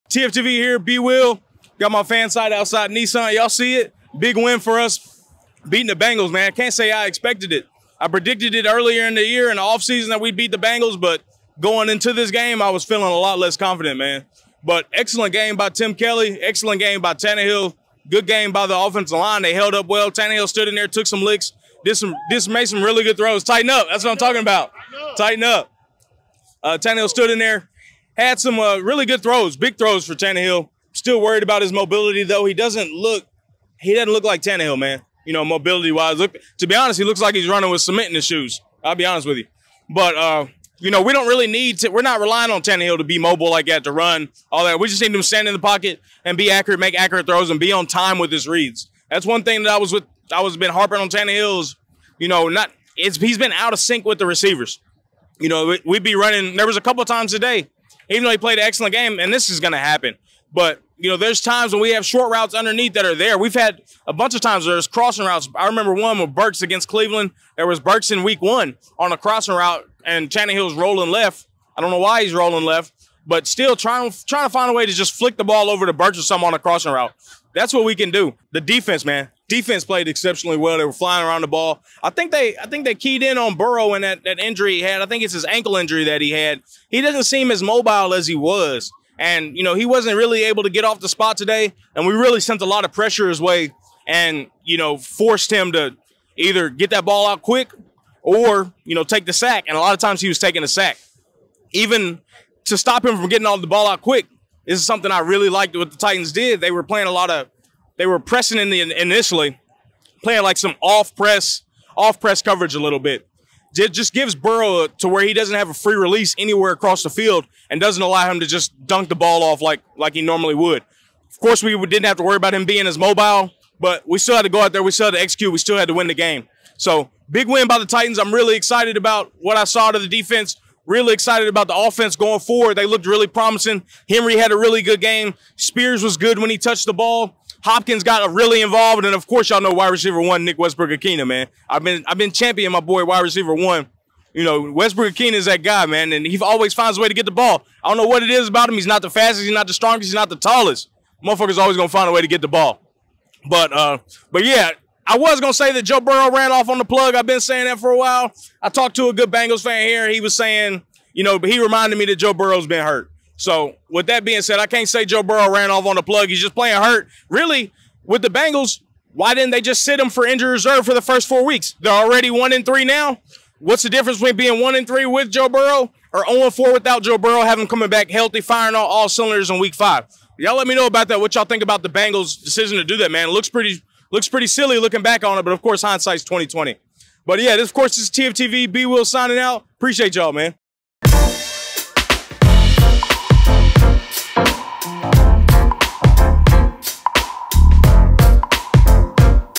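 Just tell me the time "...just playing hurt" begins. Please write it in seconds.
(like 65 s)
166 s.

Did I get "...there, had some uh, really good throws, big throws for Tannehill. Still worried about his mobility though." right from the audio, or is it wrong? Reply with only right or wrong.
right.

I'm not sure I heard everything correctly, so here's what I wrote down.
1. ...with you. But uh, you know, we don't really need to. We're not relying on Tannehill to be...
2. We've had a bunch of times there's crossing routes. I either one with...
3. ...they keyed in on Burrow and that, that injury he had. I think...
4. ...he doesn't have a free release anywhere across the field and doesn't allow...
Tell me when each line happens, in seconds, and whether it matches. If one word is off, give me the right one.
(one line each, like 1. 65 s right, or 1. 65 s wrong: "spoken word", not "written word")
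1. 39 s right
2. 63 s wrong: "remember", not "either"
3. 82 s right
4. 115 s right.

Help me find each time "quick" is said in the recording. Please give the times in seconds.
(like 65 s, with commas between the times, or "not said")
97 s, 104 s.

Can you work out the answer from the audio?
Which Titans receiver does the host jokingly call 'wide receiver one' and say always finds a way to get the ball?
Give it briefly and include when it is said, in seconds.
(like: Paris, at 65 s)
Nick Westbrook-Ikhine, at 140 s.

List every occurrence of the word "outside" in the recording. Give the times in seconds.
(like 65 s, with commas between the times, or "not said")
2 s.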